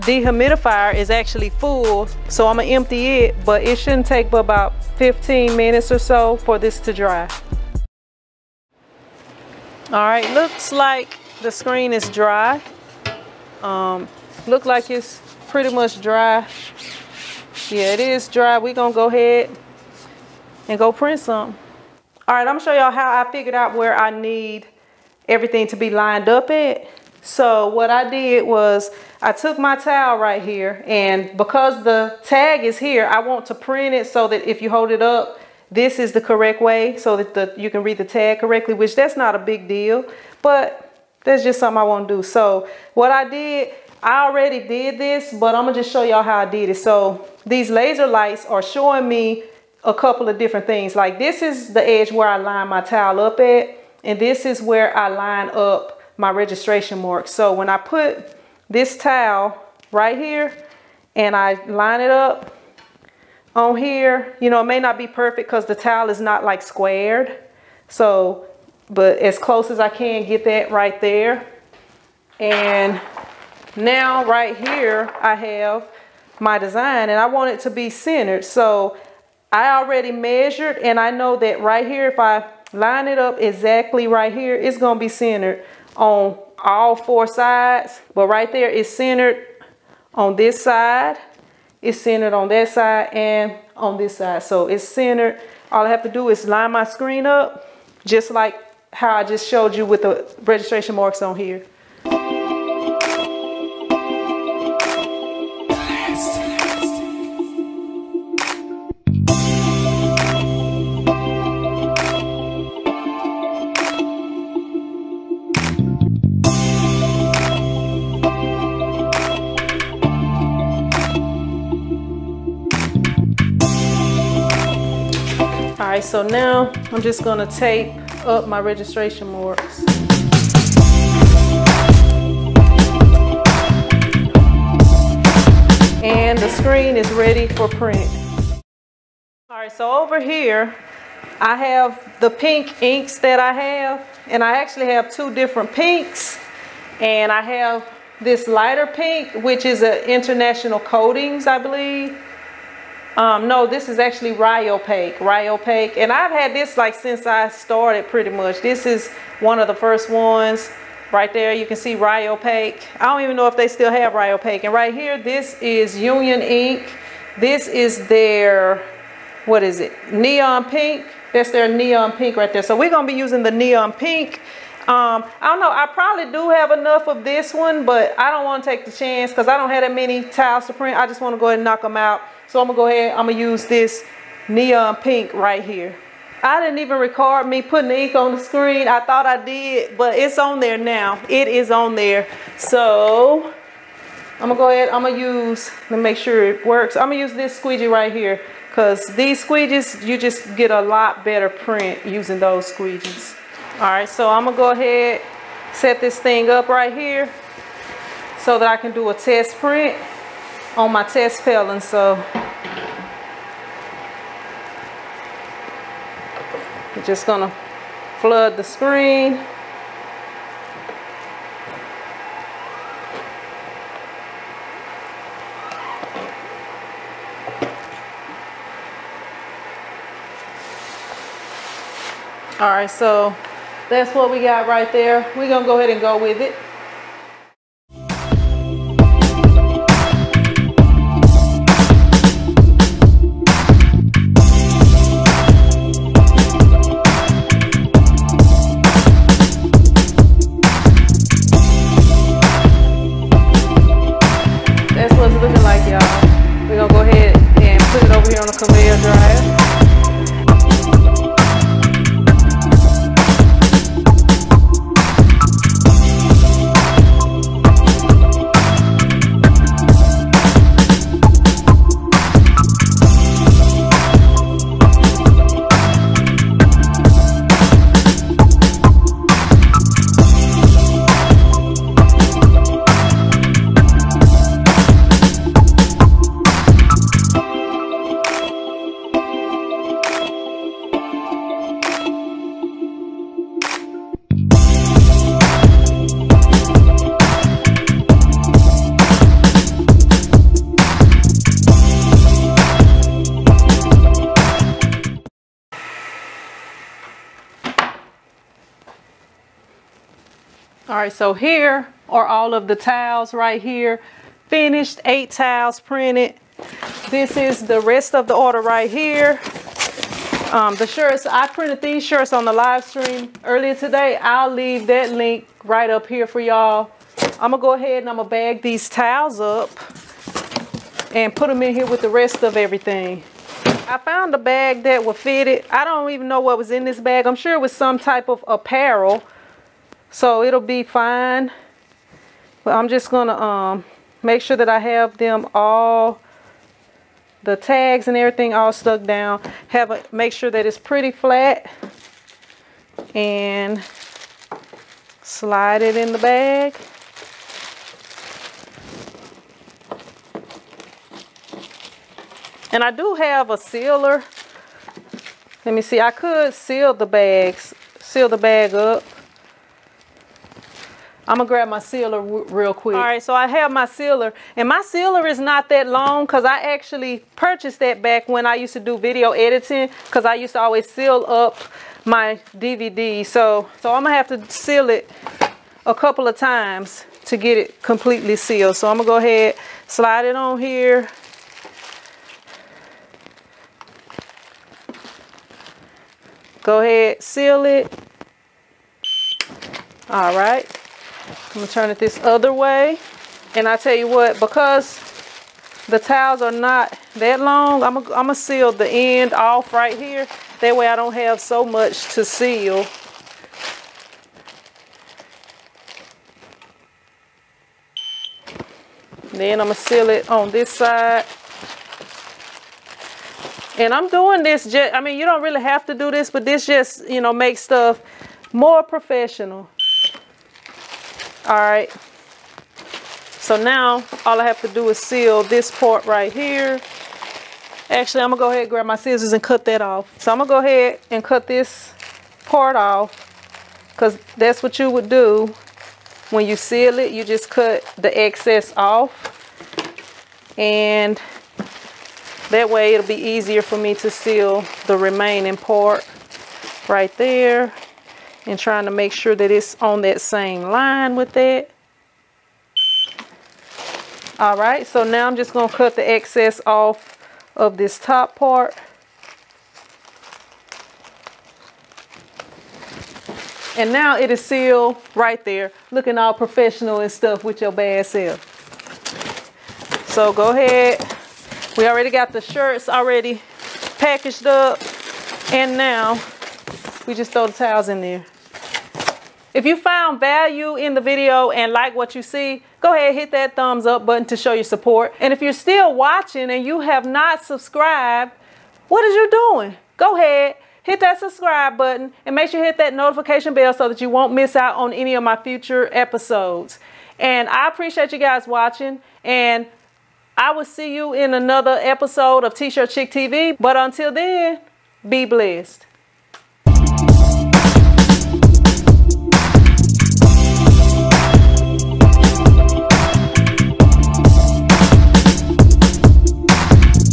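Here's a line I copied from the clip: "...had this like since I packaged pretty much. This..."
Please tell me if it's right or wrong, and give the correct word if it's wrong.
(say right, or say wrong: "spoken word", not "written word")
wrong: "started", not "packaged".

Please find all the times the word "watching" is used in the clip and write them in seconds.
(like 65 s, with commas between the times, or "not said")
495 s, 508 s.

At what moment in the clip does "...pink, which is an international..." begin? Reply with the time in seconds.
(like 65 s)
148 s.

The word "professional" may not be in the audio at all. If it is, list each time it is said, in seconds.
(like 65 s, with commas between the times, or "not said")
428 s, 476 s.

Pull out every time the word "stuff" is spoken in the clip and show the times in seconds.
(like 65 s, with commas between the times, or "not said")
427 s, 477 s.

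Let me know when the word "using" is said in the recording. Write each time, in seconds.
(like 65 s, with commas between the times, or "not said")
173 s, 202 s.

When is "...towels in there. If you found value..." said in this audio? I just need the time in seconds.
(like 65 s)
487 s.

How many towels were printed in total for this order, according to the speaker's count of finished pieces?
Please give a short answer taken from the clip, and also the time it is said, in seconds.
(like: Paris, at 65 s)
8, at 315 s.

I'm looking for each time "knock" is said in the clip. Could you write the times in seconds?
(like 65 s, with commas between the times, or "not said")
181 s.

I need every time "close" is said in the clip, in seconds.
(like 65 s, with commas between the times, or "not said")
69 s.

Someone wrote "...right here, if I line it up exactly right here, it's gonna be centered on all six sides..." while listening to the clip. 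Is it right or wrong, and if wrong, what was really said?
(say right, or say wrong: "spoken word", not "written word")
wrong: "four", not "six".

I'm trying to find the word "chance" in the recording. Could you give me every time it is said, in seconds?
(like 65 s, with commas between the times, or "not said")
178 s.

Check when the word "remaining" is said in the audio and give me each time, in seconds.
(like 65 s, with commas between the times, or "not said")
454 s.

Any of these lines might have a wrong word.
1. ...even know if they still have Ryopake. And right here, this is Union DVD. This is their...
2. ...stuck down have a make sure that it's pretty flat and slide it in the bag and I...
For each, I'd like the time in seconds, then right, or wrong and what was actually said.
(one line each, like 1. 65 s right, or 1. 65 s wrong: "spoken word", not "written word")
1. 163 s wrong: "Ink", not "DVD"
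2. 348 s right.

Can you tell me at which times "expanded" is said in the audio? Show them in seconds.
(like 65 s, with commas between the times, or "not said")
not said.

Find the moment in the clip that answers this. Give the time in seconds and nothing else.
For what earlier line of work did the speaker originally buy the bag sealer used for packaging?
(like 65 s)
378 s.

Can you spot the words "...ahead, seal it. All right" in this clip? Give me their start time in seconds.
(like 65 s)
396 s.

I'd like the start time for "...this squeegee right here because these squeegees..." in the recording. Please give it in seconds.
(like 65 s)
197 s.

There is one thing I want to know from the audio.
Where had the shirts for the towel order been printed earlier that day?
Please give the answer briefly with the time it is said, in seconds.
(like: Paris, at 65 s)
On the live stream, at 322 s.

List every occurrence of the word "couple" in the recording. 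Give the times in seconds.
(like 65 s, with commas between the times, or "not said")
49 s, 385 s.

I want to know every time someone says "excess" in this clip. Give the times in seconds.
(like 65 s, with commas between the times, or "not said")
448 s, 466 s.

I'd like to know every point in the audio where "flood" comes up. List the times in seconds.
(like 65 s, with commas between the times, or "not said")
218 s.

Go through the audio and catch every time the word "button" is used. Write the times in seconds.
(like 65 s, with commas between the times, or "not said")
494 s, 501 s.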